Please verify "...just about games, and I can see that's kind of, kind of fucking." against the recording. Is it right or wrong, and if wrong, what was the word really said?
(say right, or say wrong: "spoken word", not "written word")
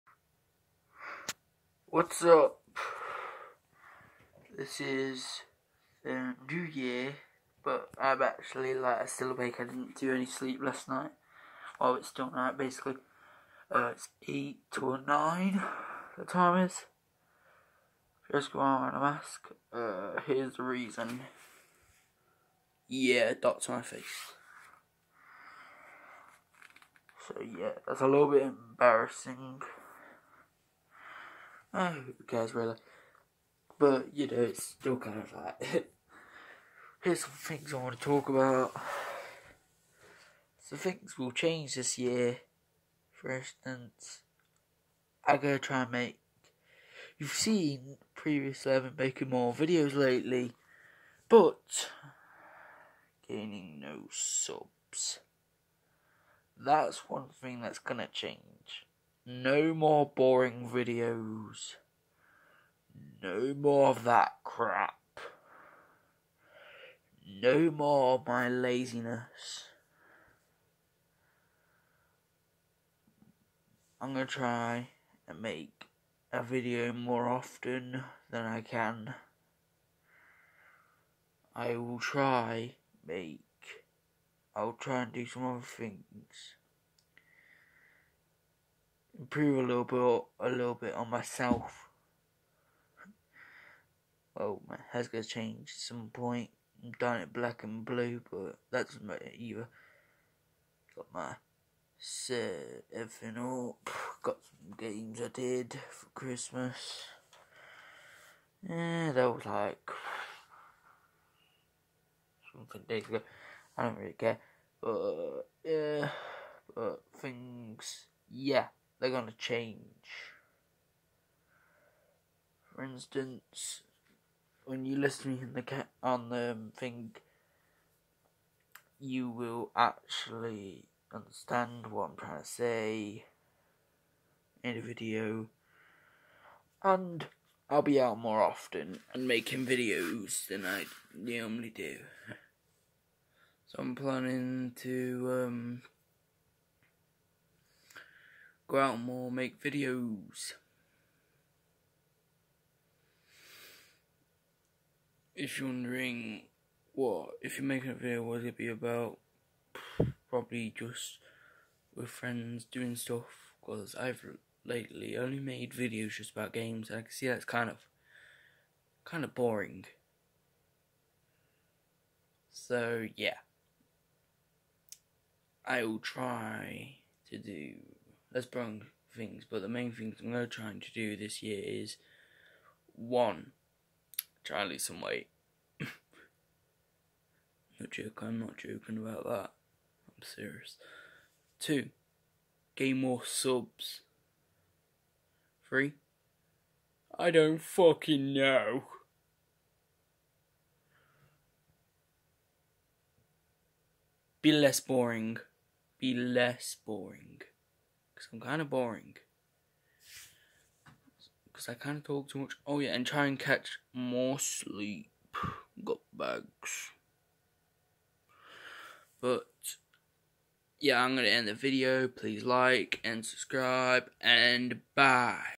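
wrong: "boring", not "fucking".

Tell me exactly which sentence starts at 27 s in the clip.
So yeah, that's a little bit embarrassing.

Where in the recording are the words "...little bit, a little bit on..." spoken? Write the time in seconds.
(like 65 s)
89 s.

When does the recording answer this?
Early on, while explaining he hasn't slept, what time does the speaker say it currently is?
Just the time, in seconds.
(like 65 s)
14 s.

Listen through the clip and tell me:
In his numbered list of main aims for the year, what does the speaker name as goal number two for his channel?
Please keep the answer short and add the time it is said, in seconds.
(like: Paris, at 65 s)
Gain more subs, at 192 s.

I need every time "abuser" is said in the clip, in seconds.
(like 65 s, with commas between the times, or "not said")
not said.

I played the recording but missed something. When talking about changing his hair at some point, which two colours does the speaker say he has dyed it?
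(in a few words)
Black and blue.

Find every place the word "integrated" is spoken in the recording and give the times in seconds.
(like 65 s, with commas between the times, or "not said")
not said.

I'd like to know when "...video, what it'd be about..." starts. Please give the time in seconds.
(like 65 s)
157 s.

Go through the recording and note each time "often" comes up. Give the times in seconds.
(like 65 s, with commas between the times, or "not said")
77 s, 138 s.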